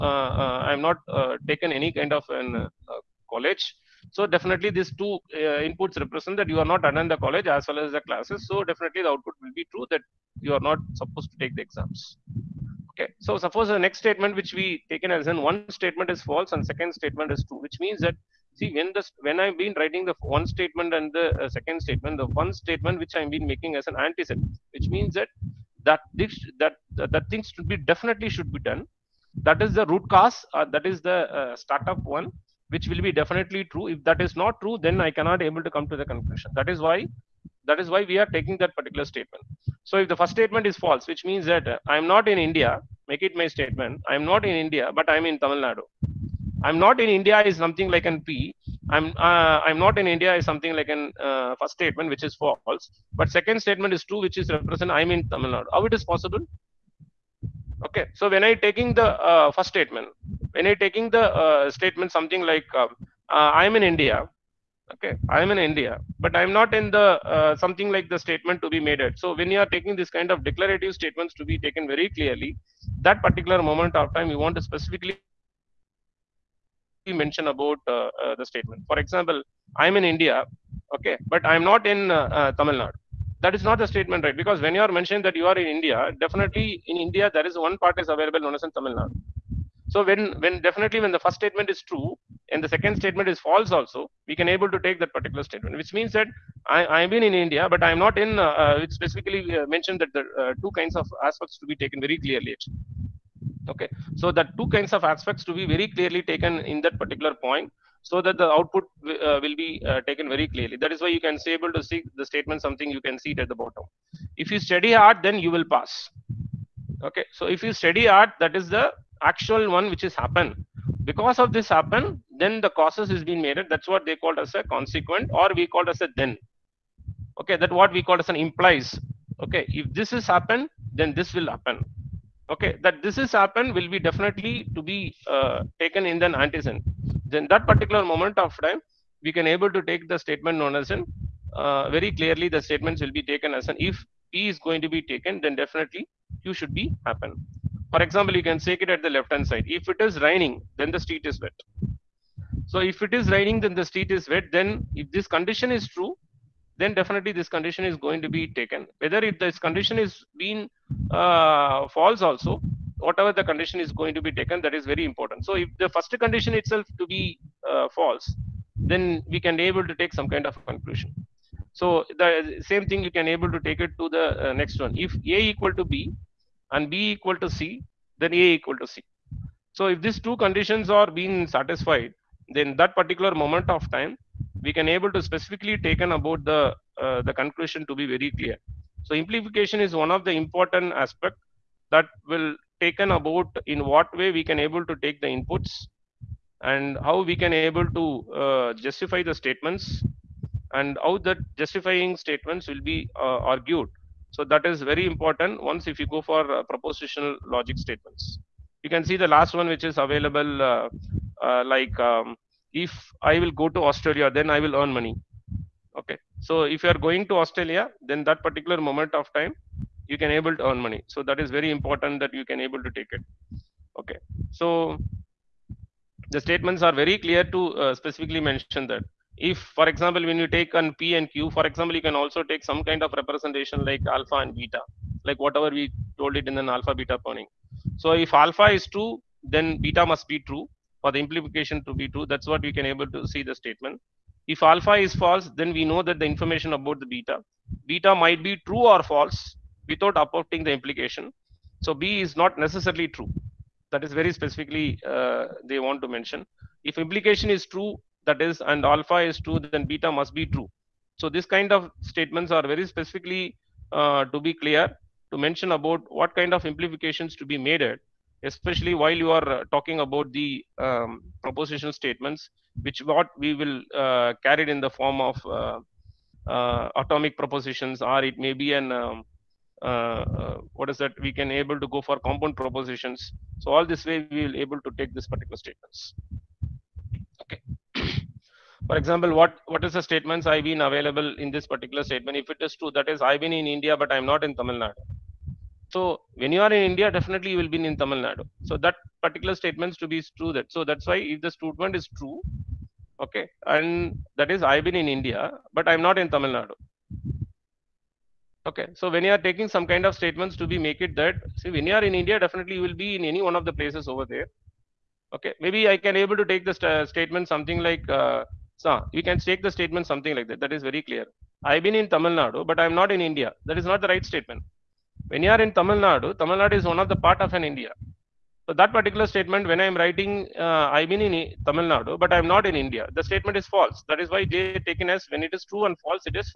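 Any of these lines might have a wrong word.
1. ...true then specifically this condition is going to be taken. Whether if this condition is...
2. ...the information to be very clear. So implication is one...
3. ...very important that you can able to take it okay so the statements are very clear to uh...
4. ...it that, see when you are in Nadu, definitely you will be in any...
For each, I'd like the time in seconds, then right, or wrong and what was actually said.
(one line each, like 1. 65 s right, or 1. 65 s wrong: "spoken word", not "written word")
1. 155 s wrong: "definitely", not "specifically"
2. 187 s wrong: "conclusion", not "information"
3. 221 s right
4. 311 s wrong: "India", not "Nadu".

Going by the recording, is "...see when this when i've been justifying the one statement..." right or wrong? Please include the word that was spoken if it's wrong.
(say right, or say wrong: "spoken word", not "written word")
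wrong: "writing", not "justifying".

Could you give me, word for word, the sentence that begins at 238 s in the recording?
so if alpha is true then beta must be true for the implication to be true.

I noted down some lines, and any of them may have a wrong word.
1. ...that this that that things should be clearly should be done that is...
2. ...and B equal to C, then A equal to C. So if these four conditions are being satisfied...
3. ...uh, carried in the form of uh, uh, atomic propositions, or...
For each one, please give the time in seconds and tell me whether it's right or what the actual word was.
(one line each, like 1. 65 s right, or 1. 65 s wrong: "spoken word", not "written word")
1. 25 s wrong: "definitely", not "clearly"
2. 176 s wrong: "two", not "four"
3. 273 s right.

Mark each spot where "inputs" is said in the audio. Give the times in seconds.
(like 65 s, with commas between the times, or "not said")
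5 s, 195 s.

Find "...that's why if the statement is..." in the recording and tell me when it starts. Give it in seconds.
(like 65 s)
300 s.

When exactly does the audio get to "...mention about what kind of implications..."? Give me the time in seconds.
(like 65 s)
265 s.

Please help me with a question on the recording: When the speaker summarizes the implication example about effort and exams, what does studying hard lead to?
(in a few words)
you will pass.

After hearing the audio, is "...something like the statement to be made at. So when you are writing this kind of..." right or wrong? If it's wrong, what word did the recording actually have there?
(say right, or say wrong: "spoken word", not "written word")
wrong: "taking", not "writing".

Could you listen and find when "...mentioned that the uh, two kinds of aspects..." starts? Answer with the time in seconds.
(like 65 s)
99 s.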